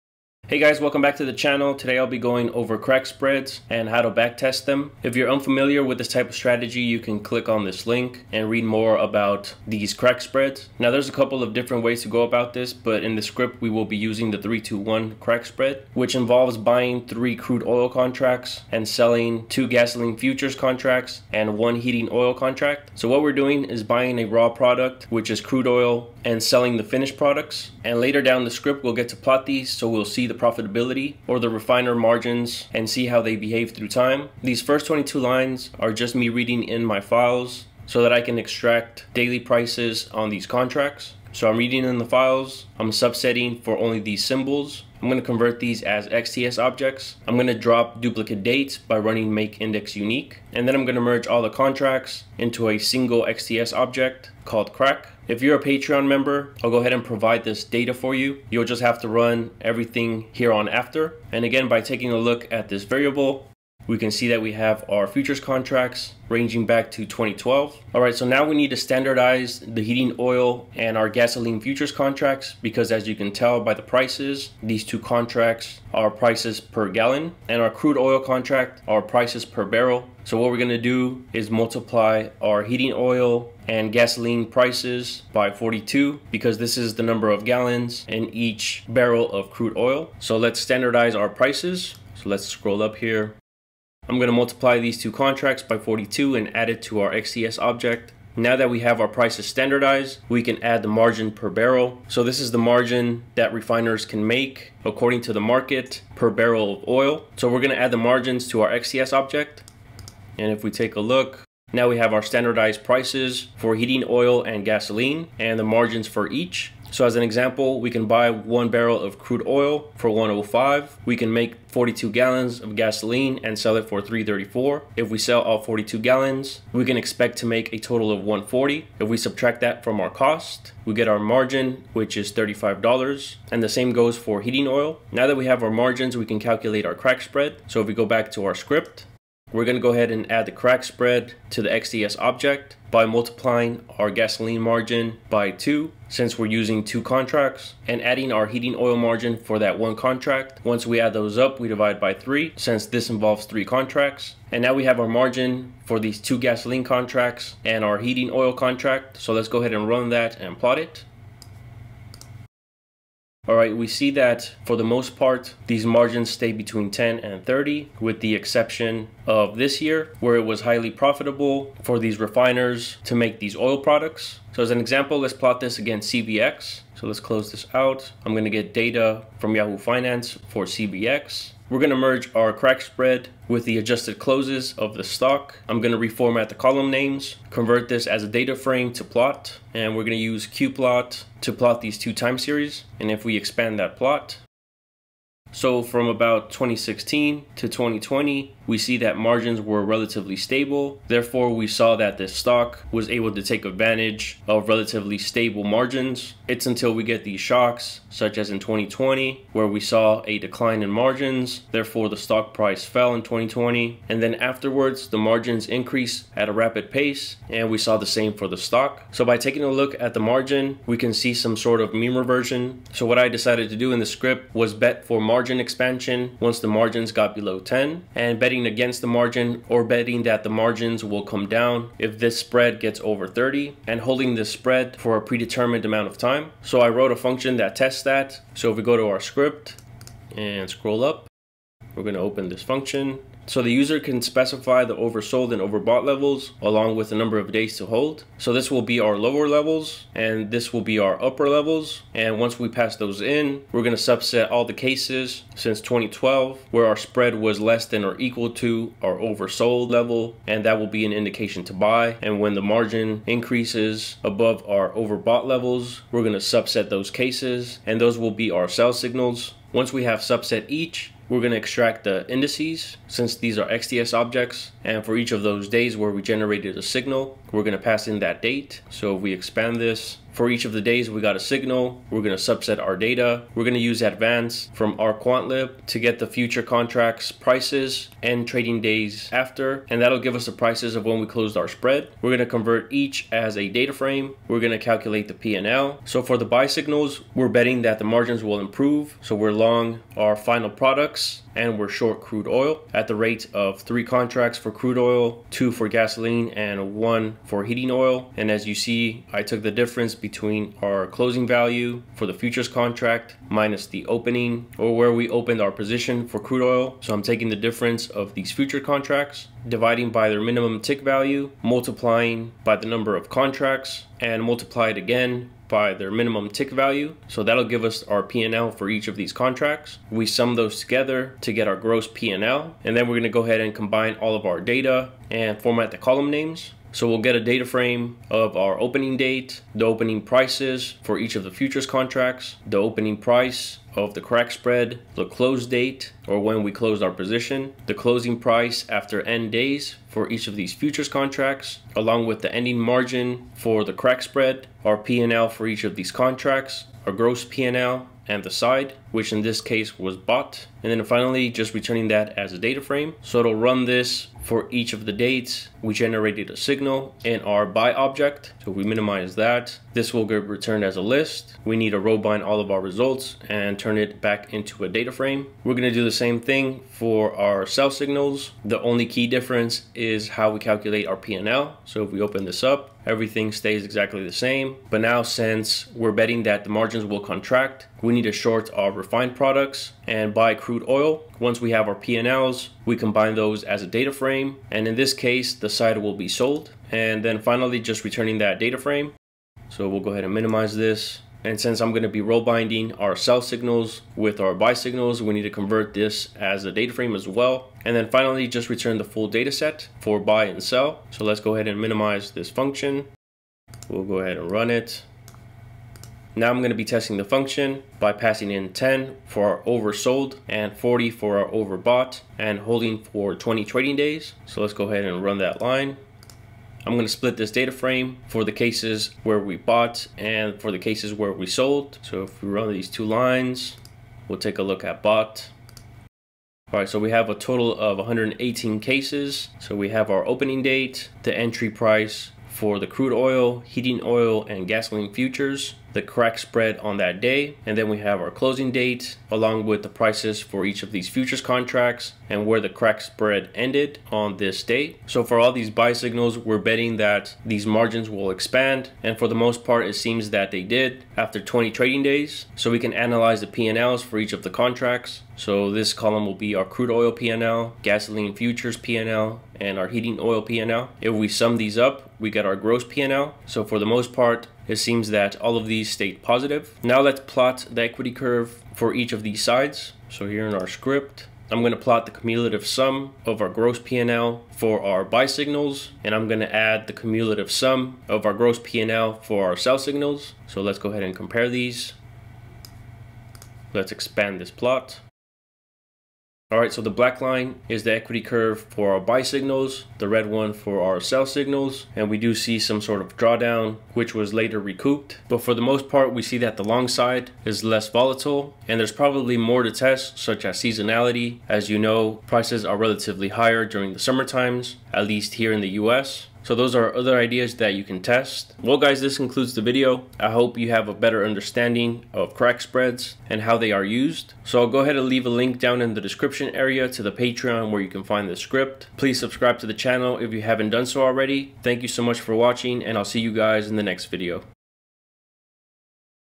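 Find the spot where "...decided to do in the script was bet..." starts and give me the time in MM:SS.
03:43.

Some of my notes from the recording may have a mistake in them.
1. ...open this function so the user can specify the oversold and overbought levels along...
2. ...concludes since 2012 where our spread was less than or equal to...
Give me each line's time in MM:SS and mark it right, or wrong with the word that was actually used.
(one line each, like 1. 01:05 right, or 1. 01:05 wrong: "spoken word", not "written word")
1. 04:02 right
2. 04:14 wrong: "cases", not "concludes".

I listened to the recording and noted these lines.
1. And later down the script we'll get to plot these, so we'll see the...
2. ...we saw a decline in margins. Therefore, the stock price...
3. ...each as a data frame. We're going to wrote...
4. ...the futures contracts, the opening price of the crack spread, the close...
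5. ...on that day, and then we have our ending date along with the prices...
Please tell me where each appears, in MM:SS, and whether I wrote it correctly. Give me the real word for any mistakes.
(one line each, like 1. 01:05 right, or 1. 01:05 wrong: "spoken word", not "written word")
1. 00:27 right
2. 03:29 right
3. 04:52 wrong: "calculate", not "wrote"
4. 05:41 right
5. 07:26 wrong: "closing", not "ending".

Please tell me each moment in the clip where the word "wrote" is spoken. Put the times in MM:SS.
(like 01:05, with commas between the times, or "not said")
03:56.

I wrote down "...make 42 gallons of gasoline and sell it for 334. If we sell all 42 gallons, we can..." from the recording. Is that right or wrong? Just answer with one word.
right.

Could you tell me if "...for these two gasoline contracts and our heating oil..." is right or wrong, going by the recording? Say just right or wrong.
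right.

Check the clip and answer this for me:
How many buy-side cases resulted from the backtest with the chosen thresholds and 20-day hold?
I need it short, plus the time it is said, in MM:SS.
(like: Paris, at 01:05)
118, at 07:17.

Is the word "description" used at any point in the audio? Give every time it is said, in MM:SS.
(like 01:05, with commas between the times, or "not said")
08:46.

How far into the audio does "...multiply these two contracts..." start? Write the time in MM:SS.
01:34.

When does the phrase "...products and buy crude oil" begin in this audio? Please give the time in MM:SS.
06:29.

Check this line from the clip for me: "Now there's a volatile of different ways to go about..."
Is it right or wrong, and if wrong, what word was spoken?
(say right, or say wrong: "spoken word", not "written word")
wrong: "couple", not "volatile".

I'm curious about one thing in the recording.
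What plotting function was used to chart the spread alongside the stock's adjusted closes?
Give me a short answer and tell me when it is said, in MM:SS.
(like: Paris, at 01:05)
qplot, at 03:10.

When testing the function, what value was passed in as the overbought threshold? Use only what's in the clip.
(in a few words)
40.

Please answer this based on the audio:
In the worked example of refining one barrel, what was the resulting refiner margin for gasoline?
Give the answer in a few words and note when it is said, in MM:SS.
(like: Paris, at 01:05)
$35, at 02:12.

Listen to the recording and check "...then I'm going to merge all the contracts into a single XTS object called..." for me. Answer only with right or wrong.
right.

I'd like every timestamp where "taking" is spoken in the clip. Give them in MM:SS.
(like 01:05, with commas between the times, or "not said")
01:01, 03:39, 05:17.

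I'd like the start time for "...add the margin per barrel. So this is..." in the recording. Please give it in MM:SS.
01:40.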